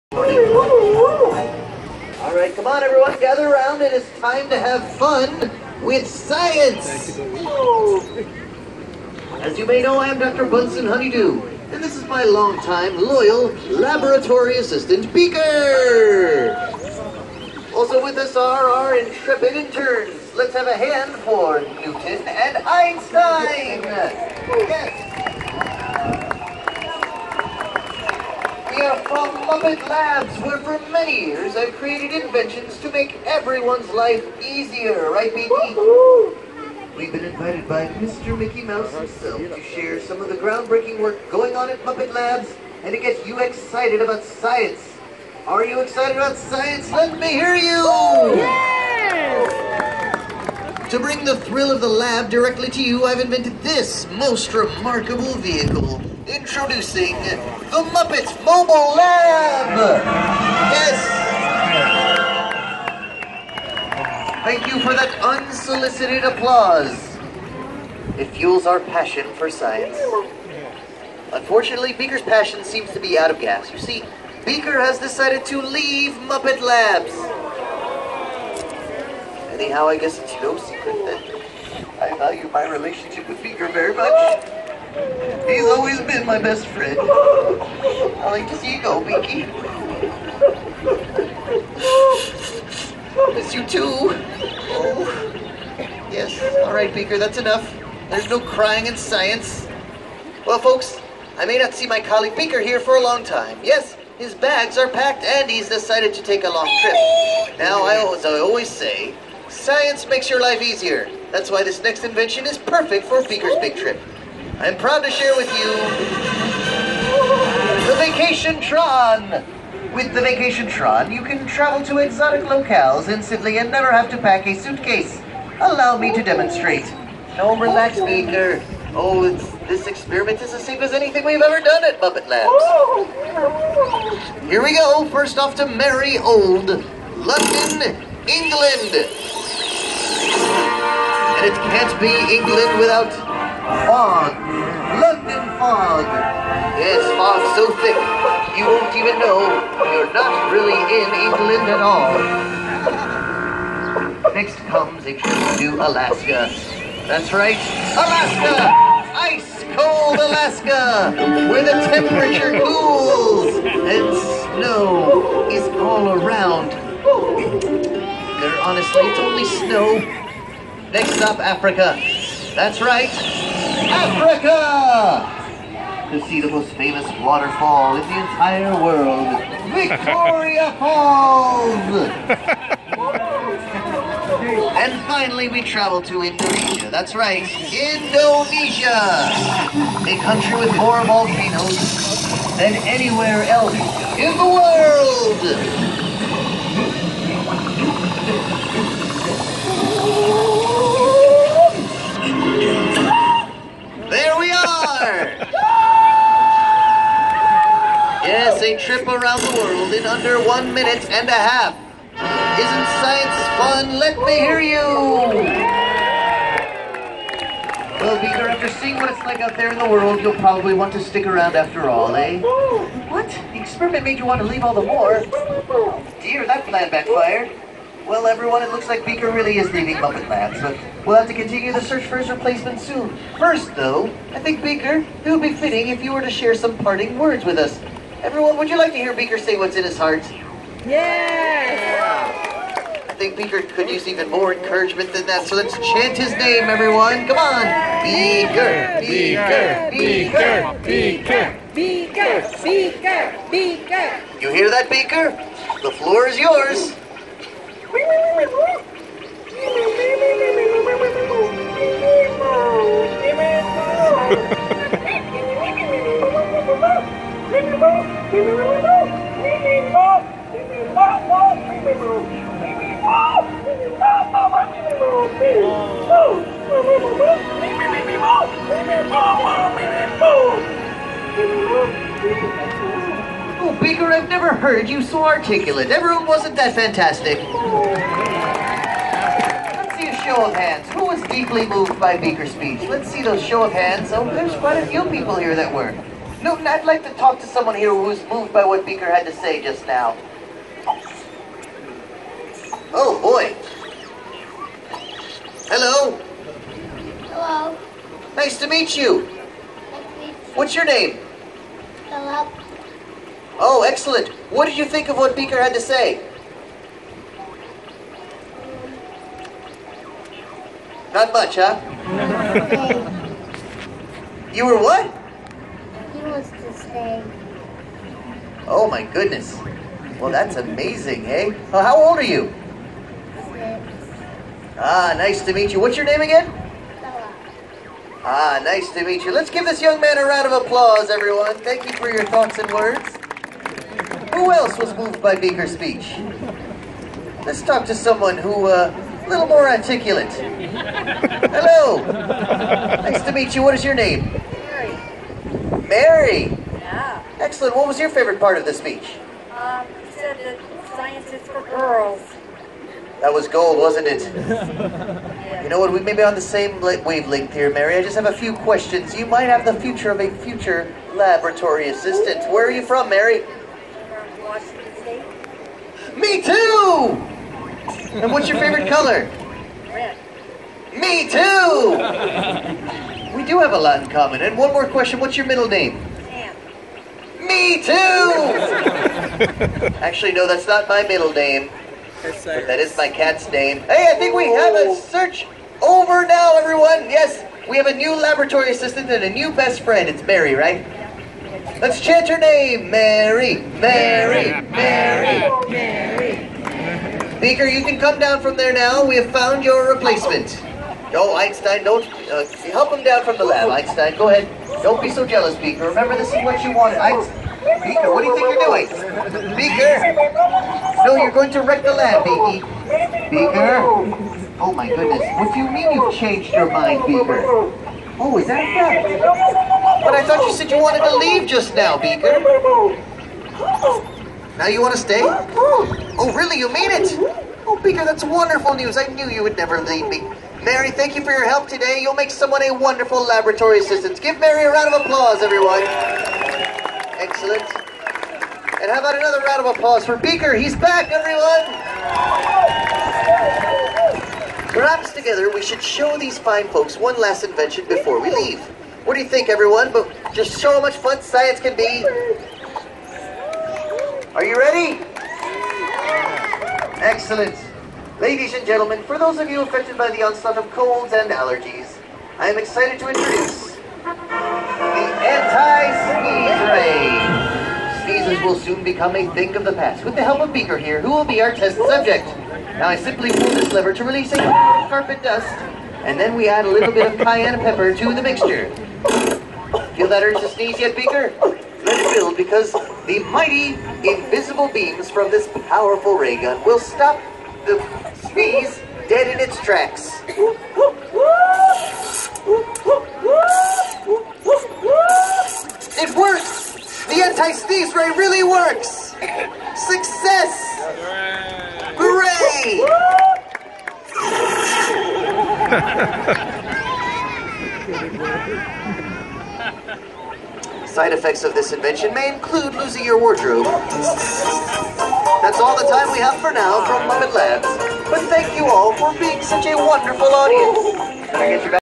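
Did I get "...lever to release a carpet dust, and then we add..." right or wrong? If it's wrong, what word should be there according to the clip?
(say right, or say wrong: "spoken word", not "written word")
right.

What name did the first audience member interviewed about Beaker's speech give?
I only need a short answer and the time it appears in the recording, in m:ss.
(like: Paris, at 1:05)
Philip, at 5:12.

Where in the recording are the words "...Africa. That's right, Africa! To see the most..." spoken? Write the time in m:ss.
2:51.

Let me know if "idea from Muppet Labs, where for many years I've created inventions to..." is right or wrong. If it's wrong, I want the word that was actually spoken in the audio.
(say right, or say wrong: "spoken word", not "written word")
right.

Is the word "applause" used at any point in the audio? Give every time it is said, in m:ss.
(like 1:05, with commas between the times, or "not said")
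1:06, 5:40, 7:25, 7:29.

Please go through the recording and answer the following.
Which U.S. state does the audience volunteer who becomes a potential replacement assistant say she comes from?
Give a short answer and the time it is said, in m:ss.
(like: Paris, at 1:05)
Washington State, at 6:14.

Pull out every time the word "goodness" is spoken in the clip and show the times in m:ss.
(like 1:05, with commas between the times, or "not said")
5:29, 7:04.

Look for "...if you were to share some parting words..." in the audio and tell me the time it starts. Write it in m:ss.
3:55.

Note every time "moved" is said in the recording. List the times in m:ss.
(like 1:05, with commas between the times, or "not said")
4:51, 4:58, 5:44.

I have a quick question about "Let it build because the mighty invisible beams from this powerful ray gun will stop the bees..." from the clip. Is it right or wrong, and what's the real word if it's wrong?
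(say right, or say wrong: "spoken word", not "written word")
right.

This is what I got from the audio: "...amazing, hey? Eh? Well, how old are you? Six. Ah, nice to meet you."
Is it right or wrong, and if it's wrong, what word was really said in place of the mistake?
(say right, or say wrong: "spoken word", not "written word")
right.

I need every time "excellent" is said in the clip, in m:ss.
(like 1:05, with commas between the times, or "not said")
5:13, 5:57, 7:27, 7:47.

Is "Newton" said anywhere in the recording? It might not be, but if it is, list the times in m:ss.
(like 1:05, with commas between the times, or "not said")
0:21, 4:56.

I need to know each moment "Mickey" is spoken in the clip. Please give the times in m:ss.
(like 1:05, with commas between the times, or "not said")
0:38.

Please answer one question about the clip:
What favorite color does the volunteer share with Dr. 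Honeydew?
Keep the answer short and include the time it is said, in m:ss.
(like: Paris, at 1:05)
Red, at 6:19.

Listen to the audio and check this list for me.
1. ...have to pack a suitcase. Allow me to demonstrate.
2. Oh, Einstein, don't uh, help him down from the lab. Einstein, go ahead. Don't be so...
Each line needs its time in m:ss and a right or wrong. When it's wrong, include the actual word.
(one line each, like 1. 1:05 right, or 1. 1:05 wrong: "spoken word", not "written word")
1. 2:03 right
2. 6:51 right.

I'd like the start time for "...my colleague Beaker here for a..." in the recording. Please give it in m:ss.
1:41.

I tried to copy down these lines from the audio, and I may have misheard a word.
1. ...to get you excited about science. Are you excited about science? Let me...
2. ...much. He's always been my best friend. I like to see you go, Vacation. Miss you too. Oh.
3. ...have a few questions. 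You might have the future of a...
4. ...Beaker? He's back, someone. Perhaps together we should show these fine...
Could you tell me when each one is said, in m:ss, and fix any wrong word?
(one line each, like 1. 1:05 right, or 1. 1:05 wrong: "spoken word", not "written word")
1. 0:42 right
2. 1:23 wrong: "Binky", not "Vacation"
3. 6:08 right
4. 7:30 wrong: "everyone", not "someone".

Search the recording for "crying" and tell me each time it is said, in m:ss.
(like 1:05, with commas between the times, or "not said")
1:38.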